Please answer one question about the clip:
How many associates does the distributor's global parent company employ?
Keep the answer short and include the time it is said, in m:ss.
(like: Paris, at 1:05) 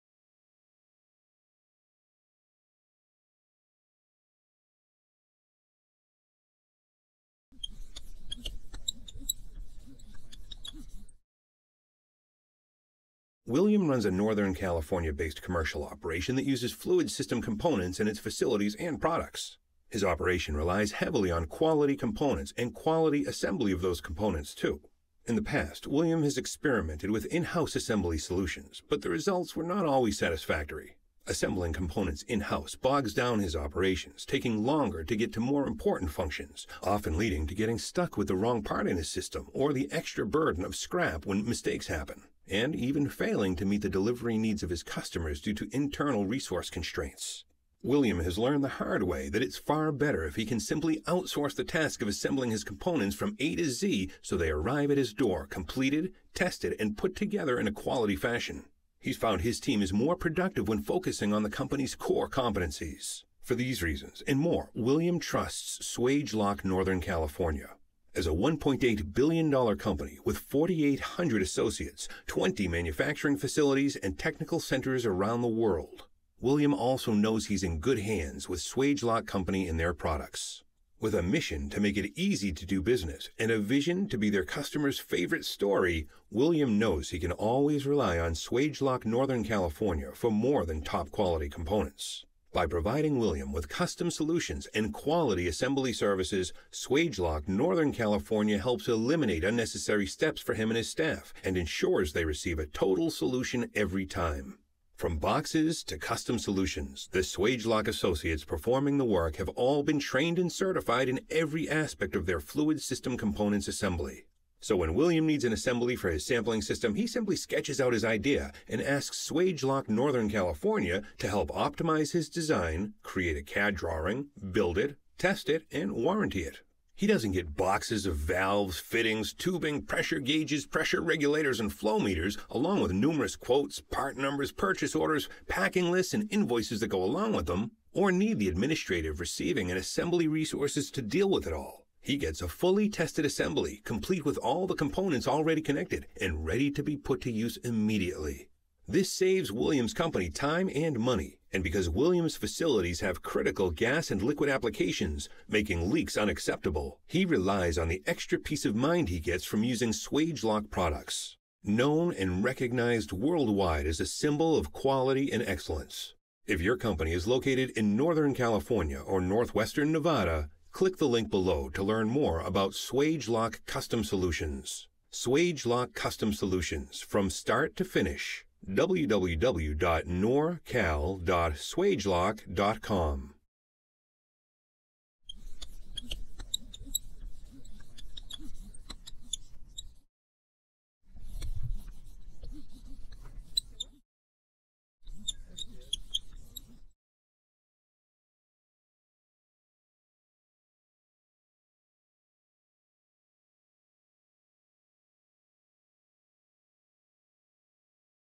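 4,800, at 1:10.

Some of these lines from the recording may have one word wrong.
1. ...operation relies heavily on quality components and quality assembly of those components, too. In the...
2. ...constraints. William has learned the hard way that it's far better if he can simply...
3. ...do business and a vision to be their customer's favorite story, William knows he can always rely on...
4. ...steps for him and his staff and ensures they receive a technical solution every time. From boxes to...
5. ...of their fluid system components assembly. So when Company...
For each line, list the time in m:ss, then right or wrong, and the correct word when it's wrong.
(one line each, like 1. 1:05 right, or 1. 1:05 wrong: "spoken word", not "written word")
1. 0:20 right
2. 0:46 right
3. 1:22 right
4. 1:40 wrong: "total", not "technical"
5. 1:52 wrong: "William", not "Company".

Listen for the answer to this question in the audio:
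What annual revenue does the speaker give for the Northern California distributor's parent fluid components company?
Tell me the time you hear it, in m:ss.
1:08.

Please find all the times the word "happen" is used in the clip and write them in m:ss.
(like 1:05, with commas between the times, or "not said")
0:41.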